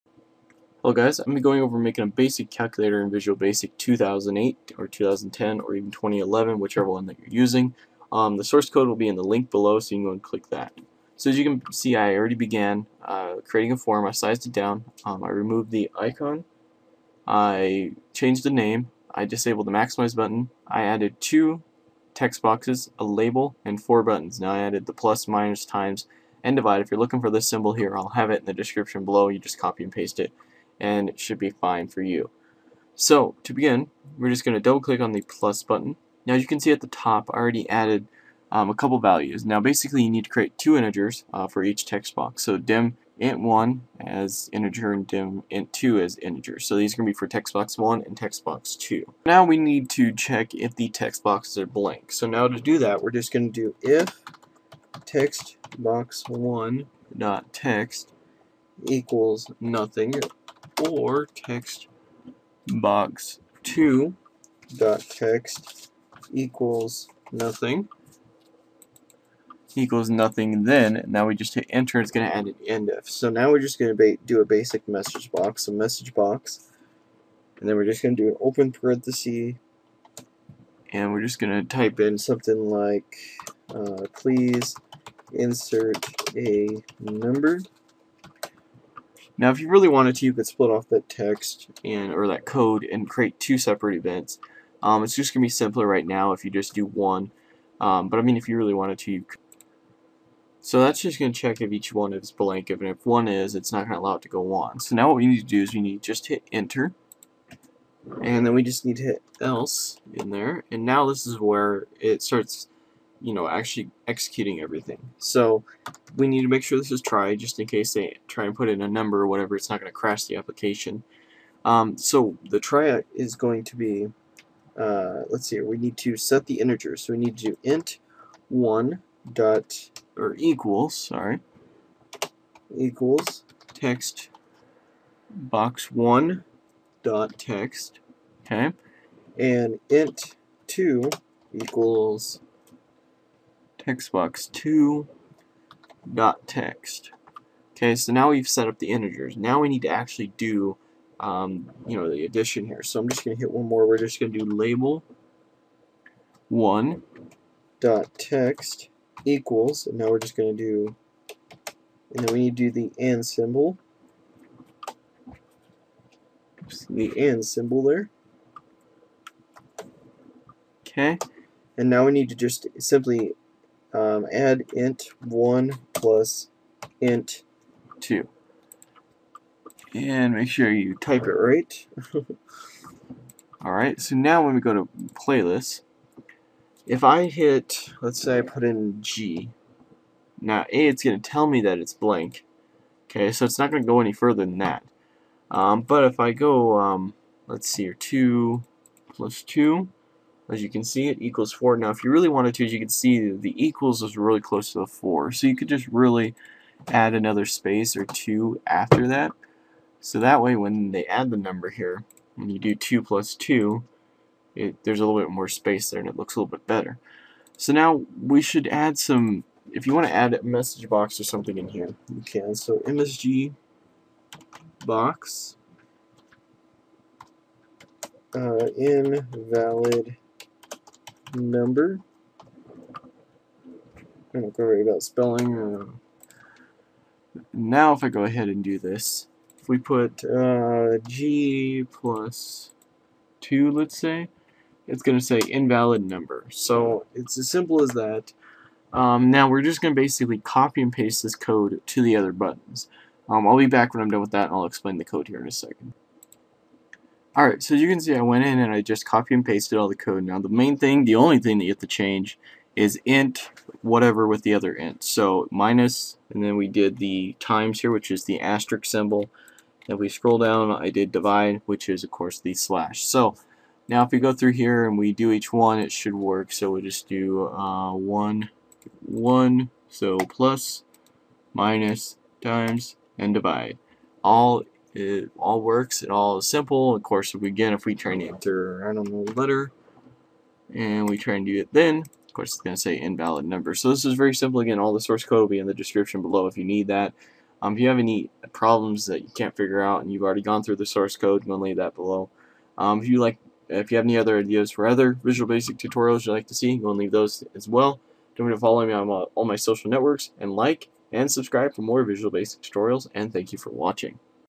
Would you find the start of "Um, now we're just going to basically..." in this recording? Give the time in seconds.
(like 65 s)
248 s.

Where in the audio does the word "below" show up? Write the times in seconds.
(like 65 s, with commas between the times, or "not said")
9 s, 29 s, 296 s, 301 s.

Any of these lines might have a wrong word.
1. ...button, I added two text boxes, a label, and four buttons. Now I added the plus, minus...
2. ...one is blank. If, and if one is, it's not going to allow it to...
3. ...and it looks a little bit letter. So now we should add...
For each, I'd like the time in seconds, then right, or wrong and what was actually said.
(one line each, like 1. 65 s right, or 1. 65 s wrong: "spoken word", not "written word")
1. 20 s right
2. 101 s right
3. 215 s wrong: "better", not "letter".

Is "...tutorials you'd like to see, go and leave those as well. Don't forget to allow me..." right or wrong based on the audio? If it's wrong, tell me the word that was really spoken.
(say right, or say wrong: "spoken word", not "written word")
wrong: "follow", not "allow".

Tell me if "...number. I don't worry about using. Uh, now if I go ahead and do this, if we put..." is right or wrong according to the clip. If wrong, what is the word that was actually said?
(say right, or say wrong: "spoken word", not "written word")
wrong: "spelling", not "using".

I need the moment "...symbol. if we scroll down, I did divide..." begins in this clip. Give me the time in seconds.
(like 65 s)
268 s.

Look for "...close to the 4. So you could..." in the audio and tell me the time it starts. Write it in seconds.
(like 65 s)
204 s.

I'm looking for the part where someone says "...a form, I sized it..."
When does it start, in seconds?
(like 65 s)
13 s.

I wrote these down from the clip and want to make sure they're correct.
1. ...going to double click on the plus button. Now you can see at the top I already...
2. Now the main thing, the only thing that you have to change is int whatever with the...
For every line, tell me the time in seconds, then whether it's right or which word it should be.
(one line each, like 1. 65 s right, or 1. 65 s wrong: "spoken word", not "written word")
1. 34 s right
2. 260 s right.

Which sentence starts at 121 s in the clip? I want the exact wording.
Um, so the try is going to be, uh, let's see, we need to set the integer.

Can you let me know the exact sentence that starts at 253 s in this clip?
Um, I'll be back when I'm done with that and I'll explain the code here in a second.